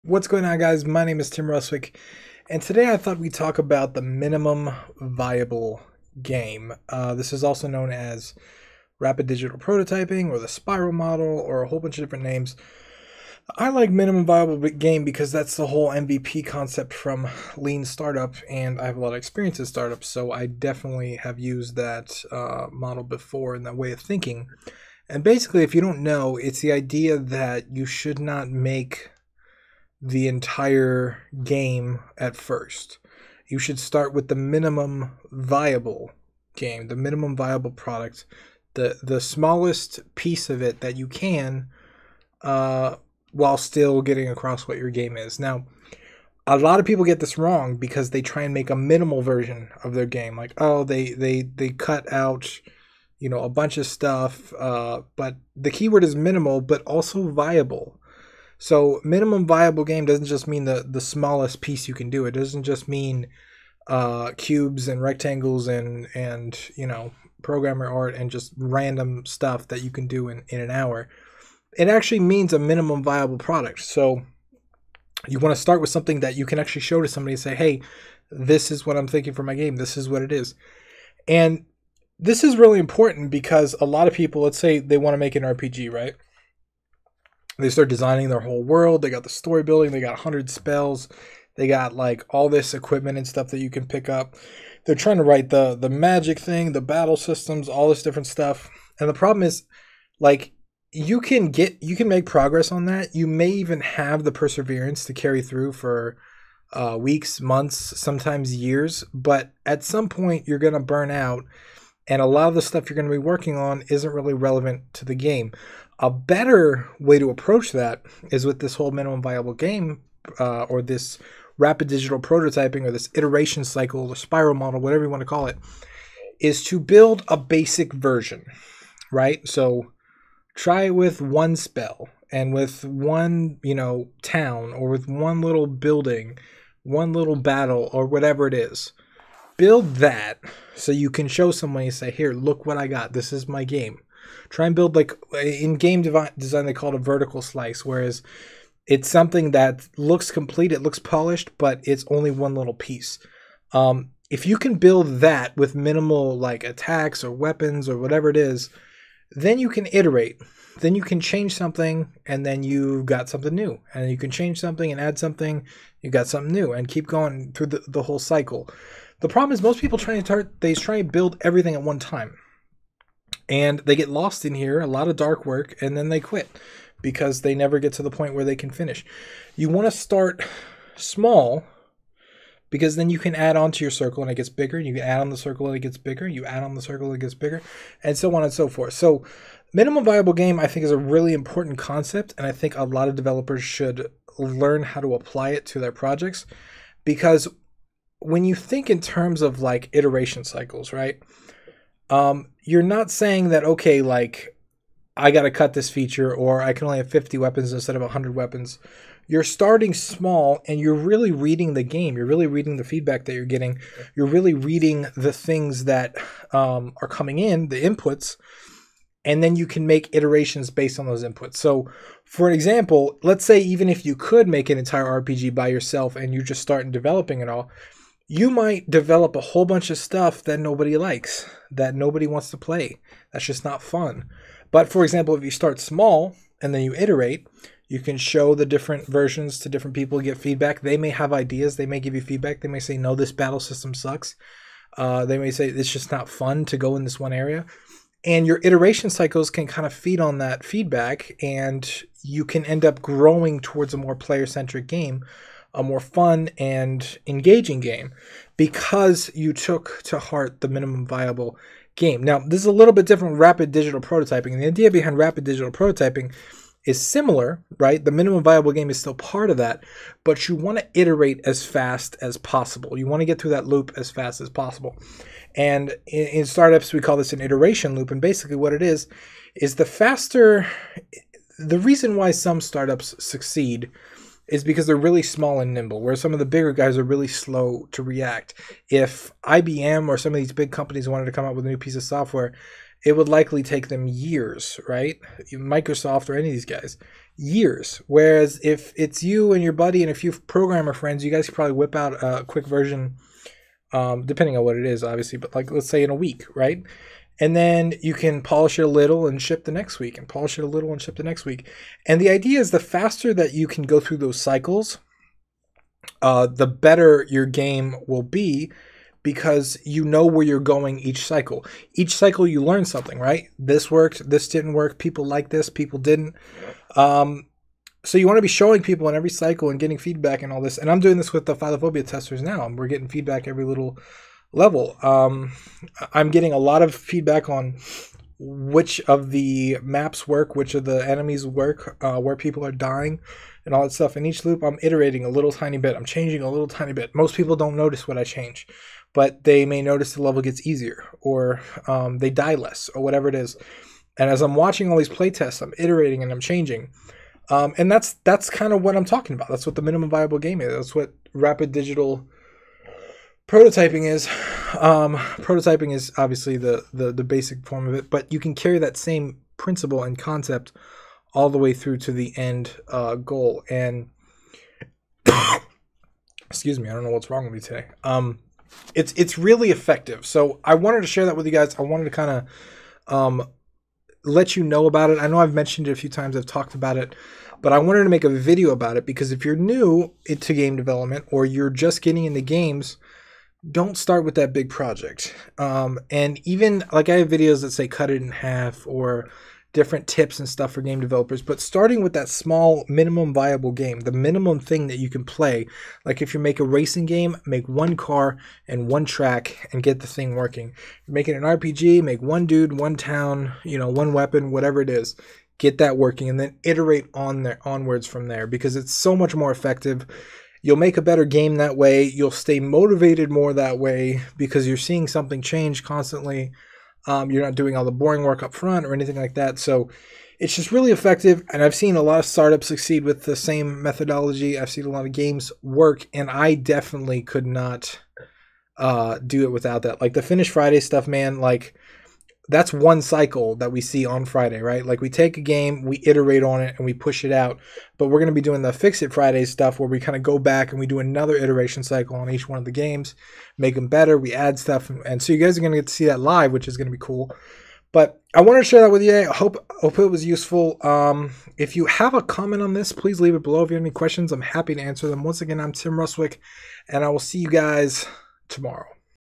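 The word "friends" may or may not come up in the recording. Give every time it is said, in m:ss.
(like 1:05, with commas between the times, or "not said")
5:00.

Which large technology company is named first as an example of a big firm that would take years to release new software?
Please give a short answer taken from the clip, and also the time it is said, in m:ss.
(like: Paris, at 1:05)
IBM, at 4:49.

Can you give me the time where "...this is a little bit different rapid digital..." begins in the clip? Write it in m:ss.
4:22.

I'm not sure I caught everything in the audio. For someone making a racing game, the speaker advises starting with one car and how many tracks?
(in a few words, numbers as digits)
1.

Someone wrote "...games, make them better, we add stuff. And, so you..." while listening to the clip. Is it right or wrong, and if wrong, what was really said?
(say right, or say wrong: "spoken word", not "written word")
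right.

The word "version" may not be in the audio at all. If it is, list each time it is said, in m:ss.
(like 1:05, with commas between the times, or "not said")
0:49, 2:07, 3:59, 5:02.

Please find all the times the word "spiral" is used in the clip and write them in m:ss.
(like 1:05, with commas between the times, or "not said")
0:10, 2:04.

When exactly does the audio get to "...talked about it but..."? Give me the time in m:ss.
6:26.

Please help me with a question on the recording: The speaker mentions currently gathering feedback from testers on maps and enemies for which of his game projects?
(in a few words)
Philophobia.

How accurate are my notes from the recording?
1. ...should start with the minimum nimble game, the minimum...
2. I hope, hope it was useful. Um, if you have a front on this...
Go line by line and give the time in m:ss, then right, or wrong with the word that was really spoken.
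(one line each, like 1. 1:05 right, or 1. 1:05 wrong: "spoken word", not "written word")
1. 0:33 wrong: "viable", not "nimble"
2. 7:39 wrong: "comment", not "front".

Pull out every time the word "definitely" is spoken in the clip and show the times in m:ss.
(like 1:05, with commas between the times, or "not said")
0:20, 7:16.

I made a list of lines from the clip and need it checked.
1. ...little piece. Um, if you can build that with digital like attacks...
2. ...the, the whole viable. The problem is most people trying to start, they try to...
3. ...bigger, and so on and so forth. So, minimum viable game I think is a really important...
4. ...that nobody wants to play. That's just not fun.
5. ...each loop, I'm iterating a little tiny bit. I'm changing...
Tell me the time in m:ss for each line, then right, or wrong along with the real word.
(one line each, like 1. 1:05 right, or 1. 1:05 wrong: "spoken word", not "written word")
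1. 2:32 wrong: "minimal", not "digital"
2. 2:47 wrong: "cycle", not "viable"
3. 3:07 right
4. 3:51 right
5. 5:44 right.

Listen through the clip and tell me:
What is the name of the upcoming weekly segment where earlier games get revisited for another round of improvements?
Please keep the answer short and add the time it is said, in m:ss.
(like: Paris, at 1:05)
Fix It Friday, at 7:28.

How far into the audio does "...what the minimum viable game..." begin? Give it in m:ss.
5:59.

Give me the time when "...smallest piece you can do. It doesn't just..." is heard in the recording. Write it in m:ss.
1:01.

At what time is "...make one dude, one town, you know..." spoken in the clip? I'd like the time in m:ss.
6:52.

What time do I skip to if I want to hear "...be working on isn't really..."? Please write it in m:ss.
1:53.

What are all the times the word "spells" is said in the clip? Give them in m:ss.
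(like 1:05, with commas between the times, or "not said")
1:30, 2:11.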